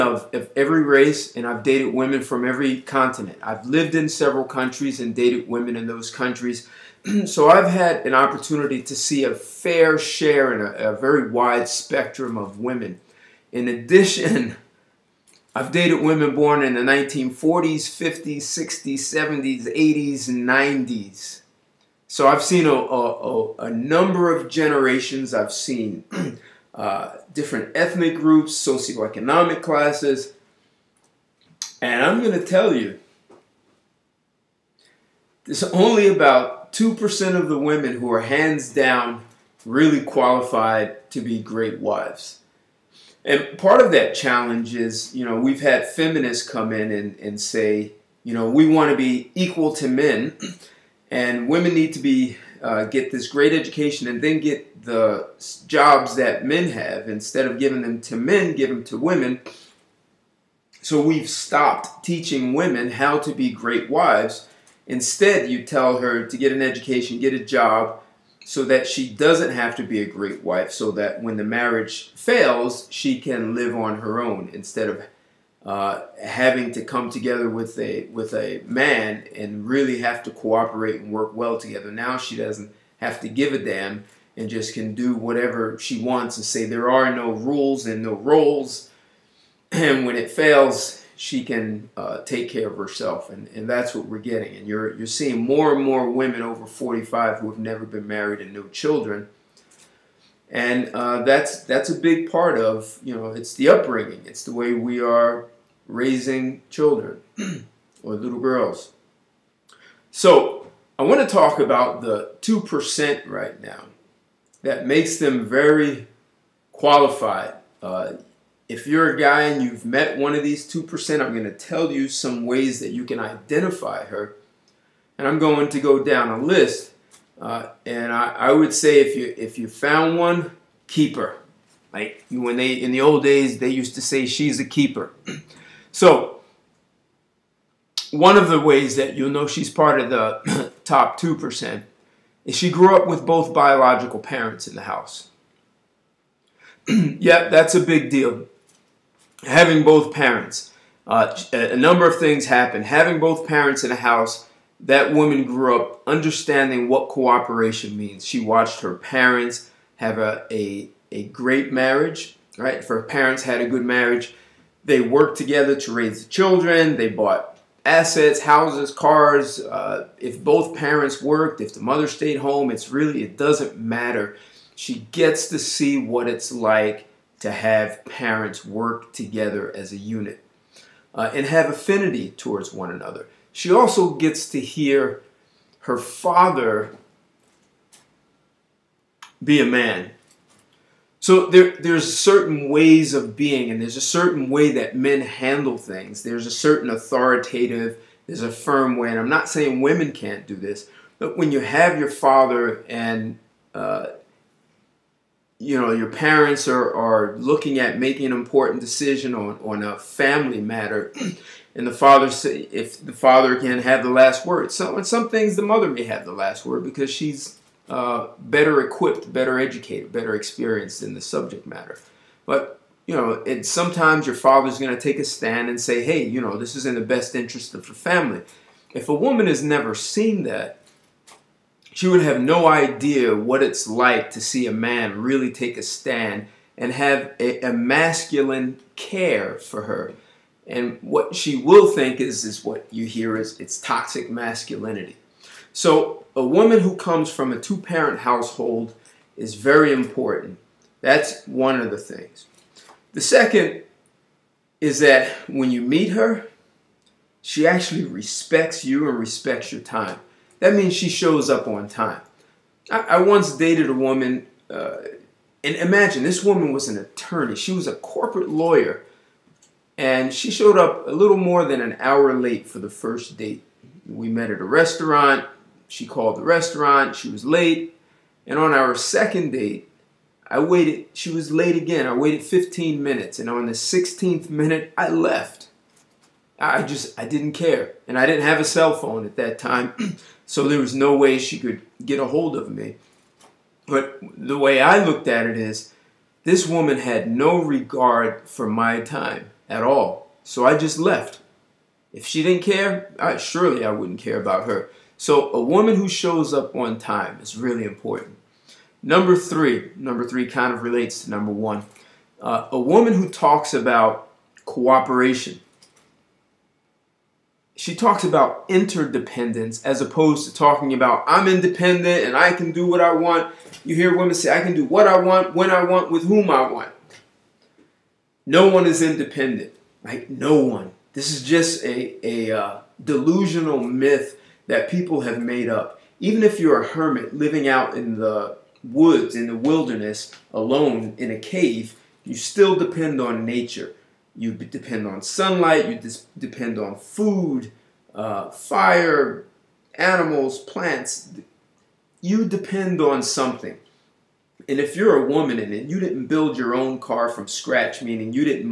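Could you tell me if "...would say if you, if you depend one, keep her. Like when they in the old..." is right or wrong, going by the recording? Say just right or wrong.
wrong.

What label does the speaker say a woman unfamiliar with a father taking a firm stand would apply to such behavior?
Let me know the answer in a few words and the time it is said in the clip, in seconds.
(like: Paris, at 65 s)
Toxic masculinity, at 243 s.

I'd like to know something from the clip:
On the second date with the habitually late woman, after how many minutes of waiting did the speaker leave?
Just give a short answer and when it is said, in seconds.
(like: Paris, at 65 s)
16th minute, at 283 s.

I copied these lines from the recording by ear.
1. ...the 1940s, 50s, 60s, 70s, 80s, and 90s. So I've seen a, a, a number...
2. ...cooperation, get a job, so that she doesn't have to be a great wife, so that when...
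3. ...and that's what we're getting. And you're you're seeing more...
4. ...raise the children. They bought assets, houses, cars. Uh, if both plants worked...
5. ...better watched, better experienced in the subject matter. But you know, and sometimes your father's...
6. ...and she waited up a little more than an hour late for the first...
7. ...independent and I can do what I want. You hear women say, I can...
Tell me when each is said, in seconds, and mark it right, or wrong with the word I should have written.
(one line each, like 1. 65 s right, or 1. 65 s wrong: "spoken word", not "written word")
1. 16 s right
2. 66 s wrong: "education", not "cooperation"
3. 93 s right
4. 165 s wrong: "parents", not "plants"
5. 219 s wrong: "educated", not "watched"
6. 269 s wrong: "showed", not "waited"
7. 321 s right.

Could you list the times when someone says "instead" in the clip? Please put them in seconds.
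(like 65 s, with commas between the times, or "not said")
57 s, 64 s, 74 s.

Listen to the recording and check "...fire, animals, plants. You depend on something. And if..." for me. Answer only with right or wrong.
right.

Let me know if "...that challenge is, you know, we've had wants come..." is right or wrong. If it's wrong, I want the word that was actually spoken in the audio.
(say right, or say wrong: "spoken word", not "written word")
wrong: "feminists", not "wants".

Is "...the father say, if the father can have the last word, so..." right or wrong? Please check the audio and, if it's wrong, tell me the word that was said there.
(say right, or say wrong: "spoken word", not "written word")
right.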